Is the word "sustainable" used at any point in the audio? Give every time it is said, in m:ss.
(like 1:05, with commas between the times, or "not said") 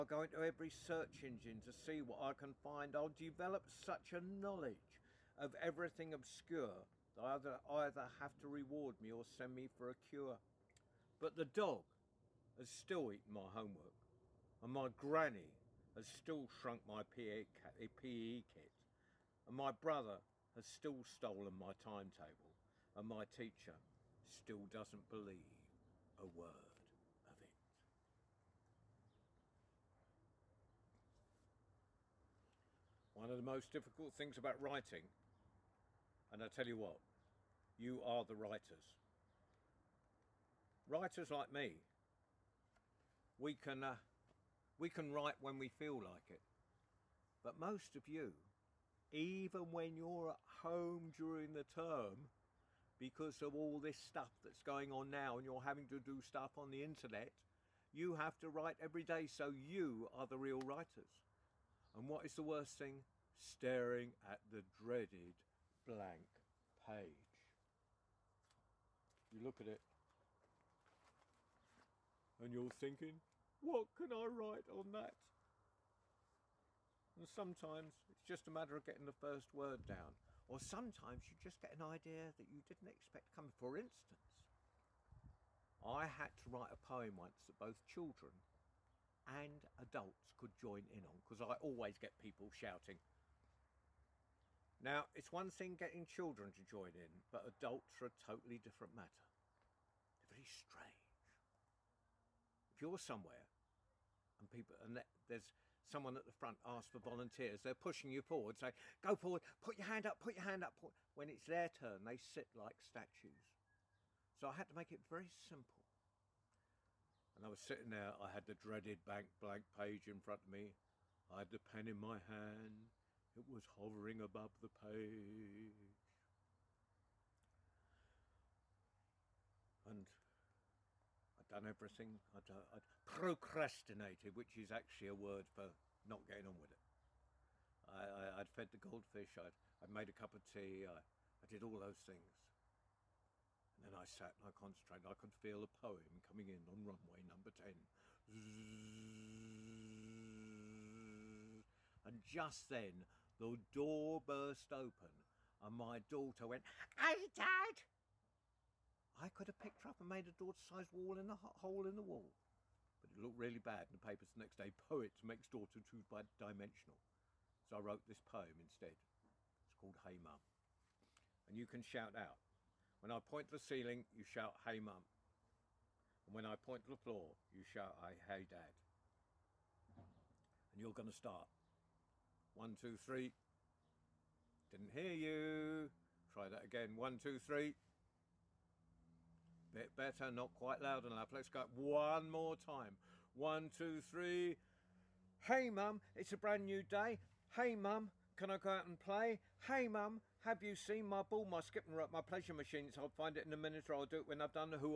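not said.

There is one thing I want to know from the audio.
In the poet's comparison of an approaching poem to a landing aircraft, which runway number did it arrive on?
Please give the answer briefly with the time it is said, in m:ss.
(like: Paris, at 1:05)
10, at 2:27.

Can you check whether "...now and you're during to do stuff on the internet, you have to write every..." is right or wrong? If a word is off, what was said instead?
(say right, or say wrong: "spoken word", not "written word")
wrong: "having", not "during".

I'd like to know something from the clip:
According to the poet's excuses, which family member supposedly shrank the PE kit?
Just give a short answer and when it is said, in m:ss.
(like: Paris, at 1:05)
Granny, at 0:14.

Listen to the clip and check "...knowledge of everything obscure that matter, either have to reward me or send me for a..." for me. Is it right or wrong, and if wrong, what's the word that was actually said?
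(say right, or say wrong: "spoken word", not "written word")
wrong: "either", not "matter".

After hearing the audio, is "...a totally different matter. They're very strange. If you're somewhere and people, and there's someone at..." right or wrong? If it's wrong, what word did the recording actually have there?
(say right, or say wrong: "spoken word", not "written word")
right.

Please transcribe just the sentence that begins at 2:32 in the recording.
And just then, the door burst open and my daughter went, Hey, Dad!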